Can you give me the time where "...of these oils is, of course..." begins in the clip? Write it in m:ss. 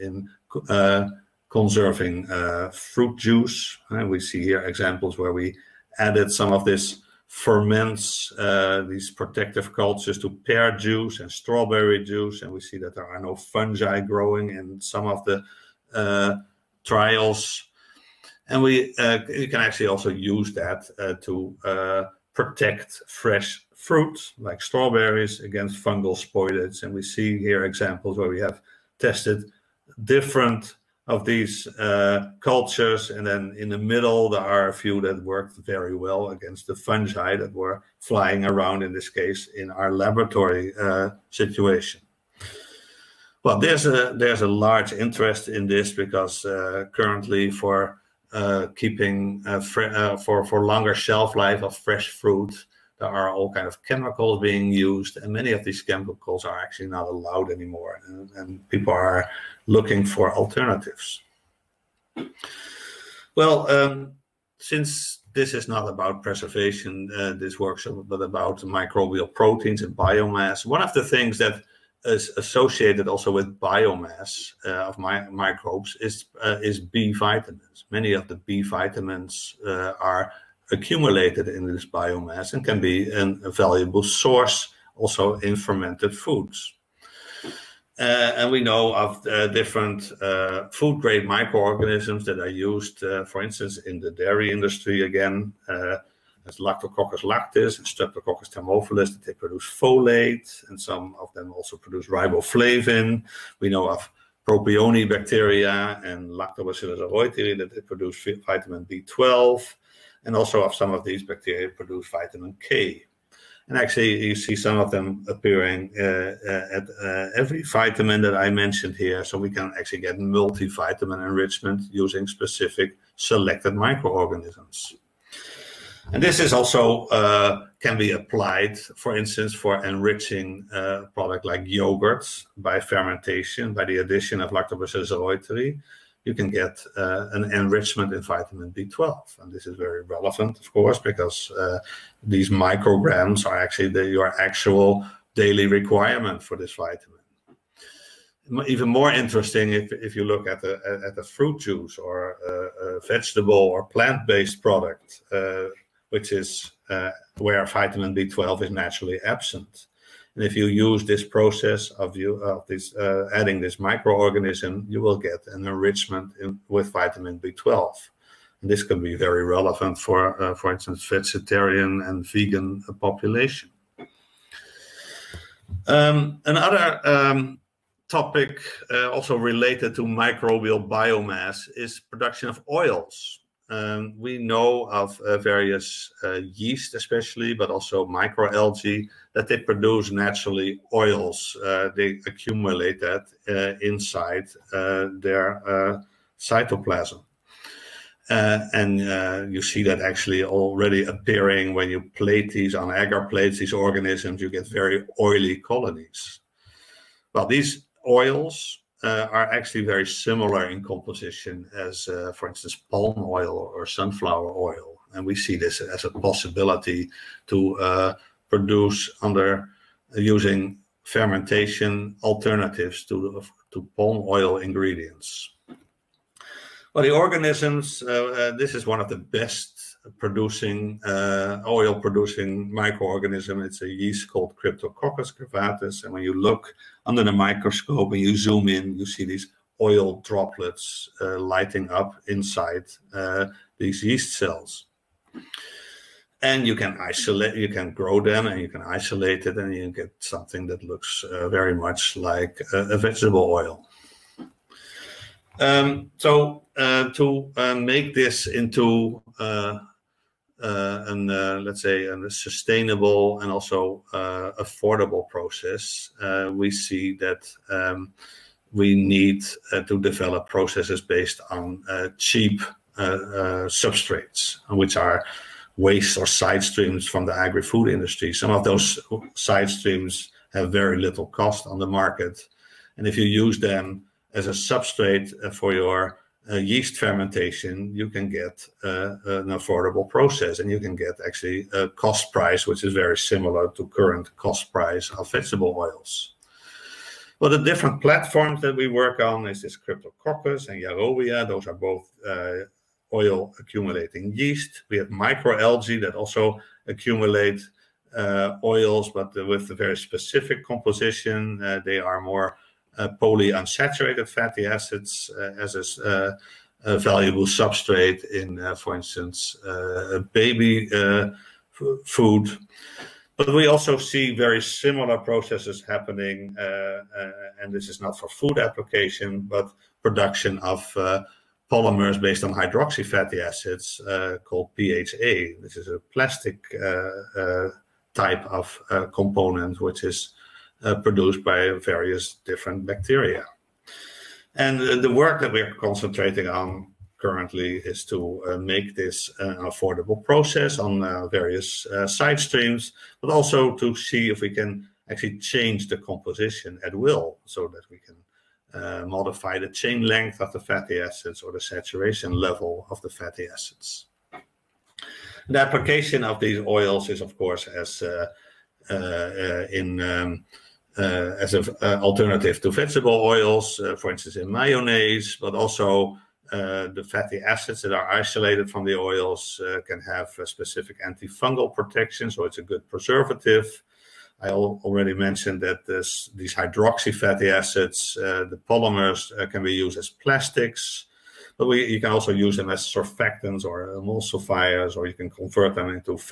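6:06.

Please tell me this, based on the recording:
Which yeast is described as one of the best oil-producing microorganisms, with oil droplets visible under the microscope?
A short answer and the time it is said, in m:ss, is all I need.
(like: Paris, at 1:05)
Cryptococcus curvatus, at 3:54.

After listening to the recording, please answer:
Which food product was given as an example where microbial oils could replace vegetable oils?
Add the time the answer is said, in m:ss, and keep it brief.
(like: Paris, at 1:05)
Mayonnaise, at 6:14.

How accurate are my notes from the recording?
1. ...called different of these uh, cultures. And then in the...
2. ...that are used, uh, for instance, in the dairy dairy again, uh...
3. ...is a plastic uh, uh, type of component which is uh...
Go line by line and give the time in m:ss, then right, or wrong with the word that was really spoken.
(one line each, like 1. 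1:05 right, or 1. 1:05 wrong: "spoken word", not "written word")
1. 0:28 wrong: "tested", not "called"
2. 1:32 wrong: "industry", not "dairy"
3. 5:35 right.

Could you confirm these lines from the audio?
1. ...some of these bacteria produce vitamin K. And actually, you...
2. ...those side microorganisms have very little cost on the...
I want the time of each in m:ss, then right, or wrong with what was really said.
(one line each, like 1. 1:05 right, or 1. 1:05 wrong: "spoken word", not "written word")
1. 1:50 right
2. 4:38 wrong: "streams", not "microorganisms".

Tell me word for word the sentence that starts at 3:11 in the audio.
Uh, they accumulate that uh, inside uh, their uh, cytoplasm.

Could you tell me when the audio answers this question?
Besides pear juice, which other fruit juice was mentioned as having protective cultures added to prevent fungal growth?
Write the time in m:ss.
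0:11.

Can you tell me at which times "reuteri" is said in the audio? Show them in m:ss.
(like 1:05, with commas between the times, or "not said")
1:46, 2:15.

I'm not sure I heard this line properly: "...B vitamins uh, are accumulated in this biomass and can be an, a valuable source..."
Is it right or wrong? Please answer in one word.
right.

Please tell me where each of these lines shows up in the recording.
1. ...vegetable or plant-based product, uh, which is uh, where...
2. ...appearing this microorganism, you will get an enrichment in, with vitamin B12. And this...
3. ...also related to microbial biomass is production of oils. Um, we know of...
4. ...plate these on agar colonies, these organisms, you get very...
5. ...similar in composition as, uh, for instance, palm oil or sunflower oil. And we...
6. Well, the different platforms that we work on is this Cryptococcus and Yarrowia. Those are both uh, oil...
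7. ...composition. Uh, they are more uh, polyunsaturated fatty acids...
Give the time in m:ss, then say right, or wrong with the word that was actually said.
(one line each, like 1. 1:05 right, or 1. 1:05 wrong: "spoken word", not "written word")
1. 2:33 right
2. 2:43 wrong: "adding", not "appearing"
3. 2:59 right
4. 3:22 wrong: "plates", not "colonies"
5. 3:30 right
6. 4:57 right
7. 5:10 right.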